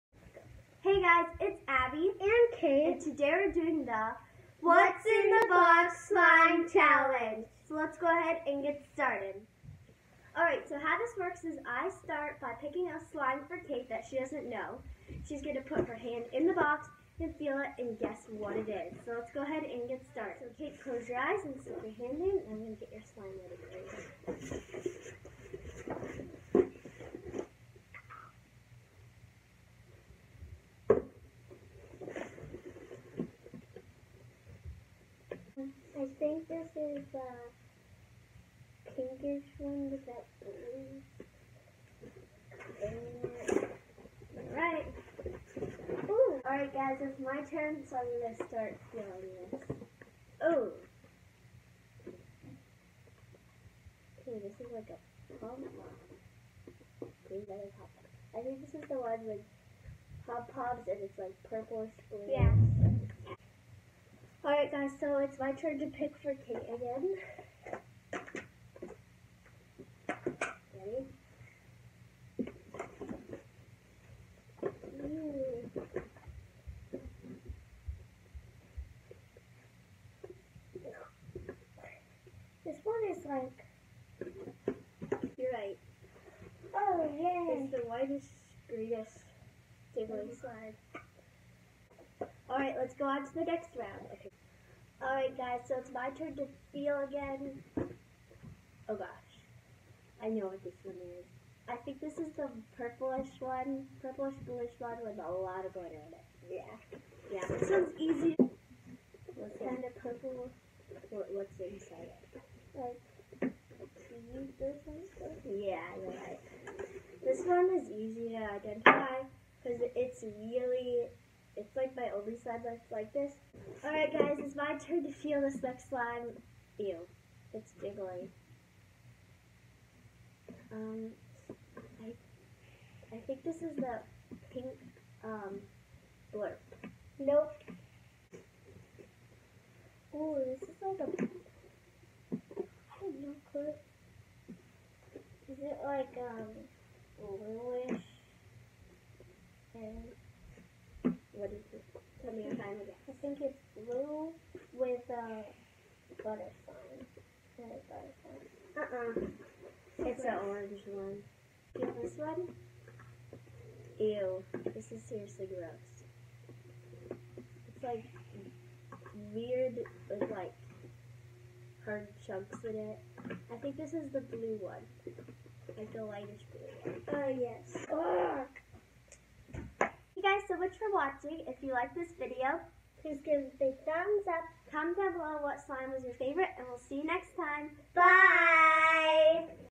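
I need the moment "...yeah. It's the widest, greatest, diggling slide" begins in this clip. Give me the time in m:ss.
1:27.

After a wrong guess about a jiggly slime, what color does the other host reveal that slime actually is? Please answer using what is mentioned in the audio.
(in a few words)
orange.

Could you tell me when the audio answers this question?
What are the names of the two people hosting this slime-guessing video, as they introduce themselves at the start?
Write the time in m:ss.
0:01.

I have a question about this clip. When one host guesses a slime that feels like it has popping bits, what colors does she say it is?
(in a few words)
purplish blue.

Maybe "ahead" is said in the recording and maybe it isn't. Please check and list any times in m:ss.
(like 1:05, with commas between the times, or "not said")
0:08, 0:19.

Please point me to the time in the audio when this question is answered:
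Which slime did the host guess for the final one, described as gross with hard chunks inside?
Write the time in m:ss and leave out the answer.
2:56.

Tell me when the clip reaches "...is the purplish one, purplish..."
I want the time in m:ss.
1:42.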